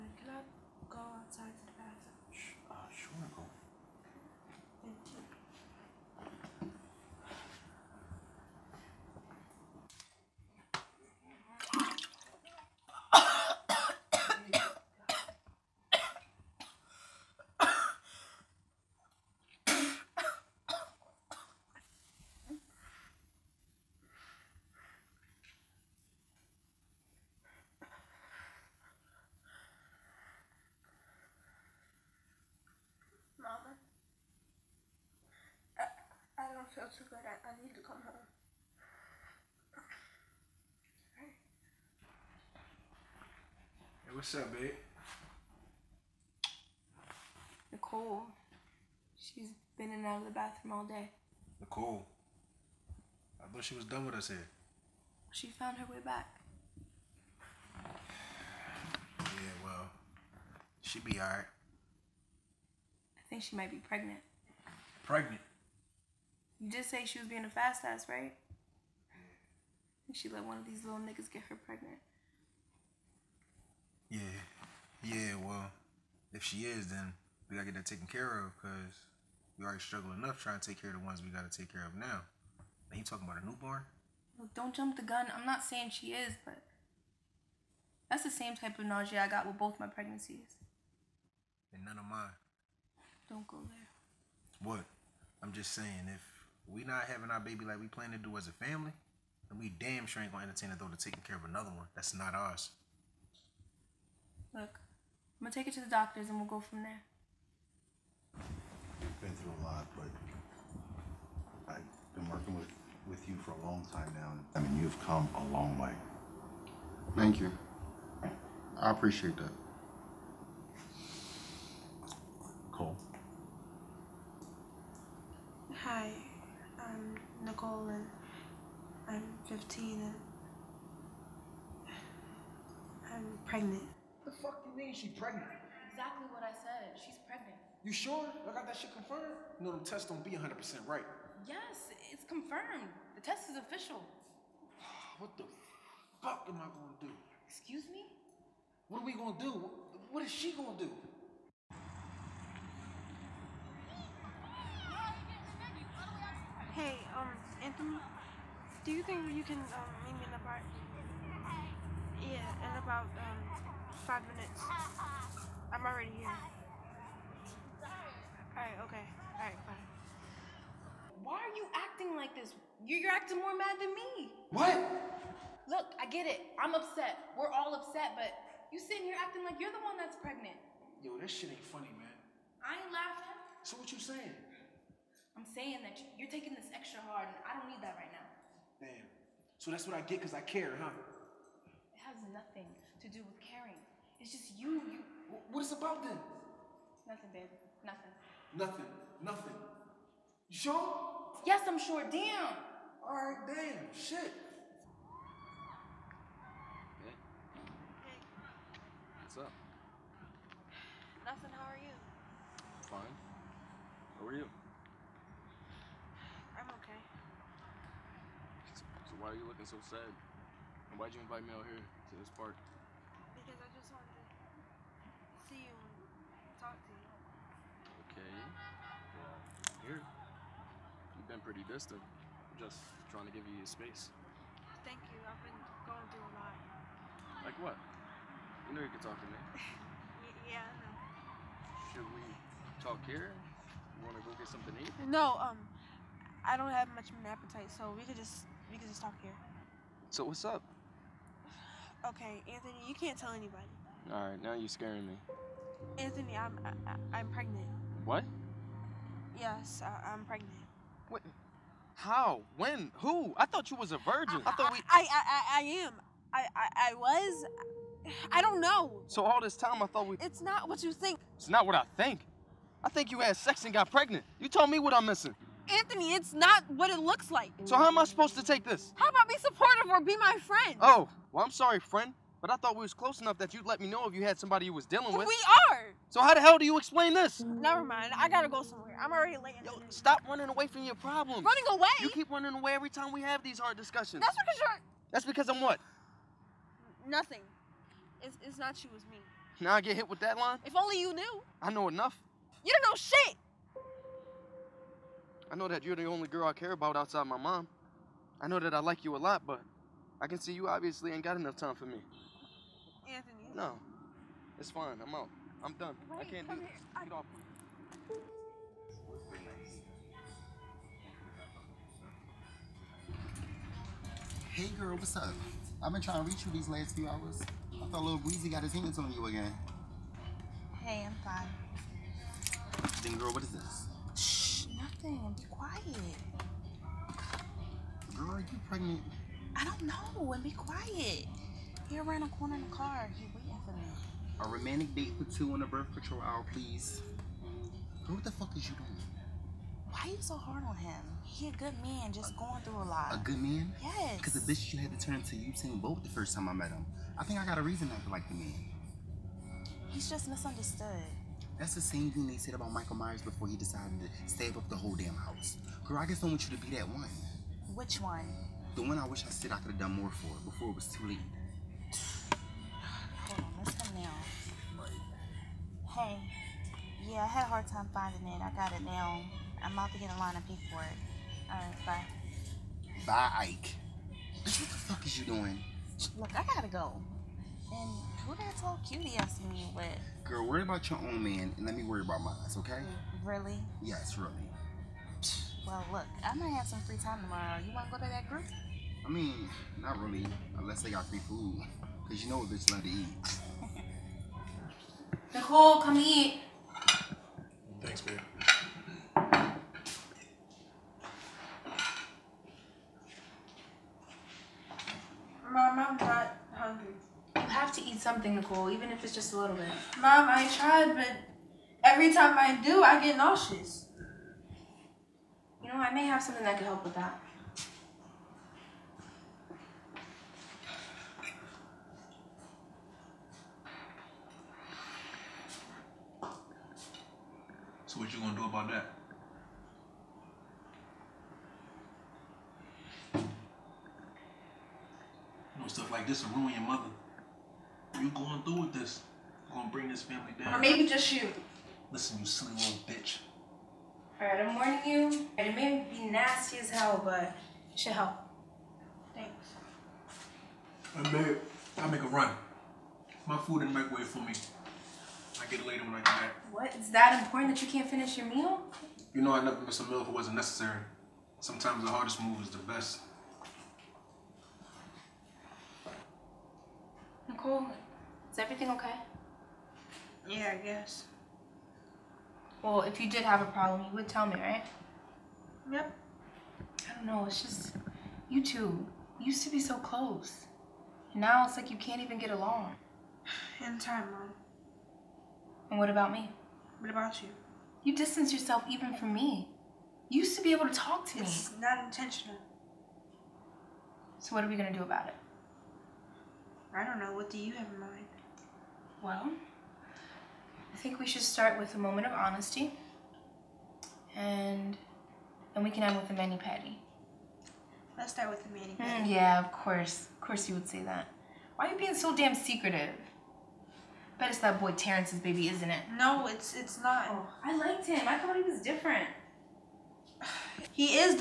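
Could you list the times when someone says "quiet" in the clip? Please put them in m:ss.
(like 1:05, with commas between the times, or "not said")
5:35, 5:40.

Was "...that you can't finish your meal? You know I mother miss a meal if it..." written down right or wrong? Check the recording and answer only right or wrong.
wrong.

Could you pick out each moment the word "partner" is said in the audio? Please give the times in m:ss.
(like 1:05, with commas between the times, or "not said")
not said.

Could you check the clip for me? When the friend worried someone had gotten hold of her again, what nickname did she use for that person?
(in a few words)
Little Breezy.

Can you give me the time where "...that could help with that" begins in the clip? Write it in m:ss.
7:06.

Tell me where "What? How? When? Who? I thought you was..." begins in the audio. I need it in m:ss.
4:21.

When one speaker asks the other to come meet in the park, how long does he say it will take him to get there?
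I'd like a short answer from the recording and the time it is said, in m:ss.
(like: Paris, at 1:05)
5 minutes, at 2:44.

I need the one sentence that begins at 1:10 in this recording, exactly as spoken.
And she let one of these little niggas get her pregnant.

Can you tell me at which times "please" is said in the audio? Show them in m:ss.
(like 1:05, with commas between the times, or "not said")
5:46.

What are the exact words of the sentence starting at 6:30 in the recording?
Girl, worry about your own man and let me worry about mine, okay?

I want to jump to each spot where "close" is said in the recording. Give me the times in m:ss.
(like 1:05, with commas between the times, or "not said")
4:42, 8:09.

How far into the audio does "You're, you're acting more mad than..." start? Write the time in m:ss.
2:52.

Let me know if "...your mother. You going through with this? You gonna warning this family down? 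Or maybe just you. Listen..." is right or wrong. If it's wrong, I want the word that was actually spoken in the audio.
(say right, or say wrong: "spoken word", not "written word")
wrong: "bring", not "warning".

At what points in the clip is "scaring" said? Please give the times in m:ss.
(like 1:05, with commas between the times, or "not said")
4:14.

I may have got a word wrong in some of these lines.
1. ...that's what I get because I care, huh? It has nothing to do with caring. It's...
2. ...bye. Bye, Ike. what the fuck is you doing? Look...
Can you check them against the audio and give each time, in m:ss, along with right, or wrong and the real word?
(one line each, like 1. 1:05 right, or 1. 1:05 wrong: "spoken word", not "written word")
1. 3:09 right
2. 6:21 right.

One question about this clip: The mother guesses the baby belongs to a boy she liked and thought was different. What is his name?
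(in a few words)
Terrence.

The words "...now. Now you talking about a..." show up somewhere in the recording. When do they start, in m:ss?
1:21.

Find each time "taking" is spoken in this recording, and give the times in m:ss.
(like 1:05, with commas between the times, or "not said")
1:40, 3:06.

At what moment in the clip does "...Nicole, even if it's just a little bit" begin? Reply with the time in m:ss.
6:58.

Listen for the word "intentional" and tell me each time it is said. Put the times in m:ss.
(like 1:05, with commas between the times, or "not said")
8:21.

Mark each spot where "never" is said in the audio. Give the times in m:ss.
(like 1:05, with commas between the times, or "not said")
4:47, 7:49.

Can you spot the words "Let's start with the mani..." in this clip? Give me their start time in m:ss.
8:37.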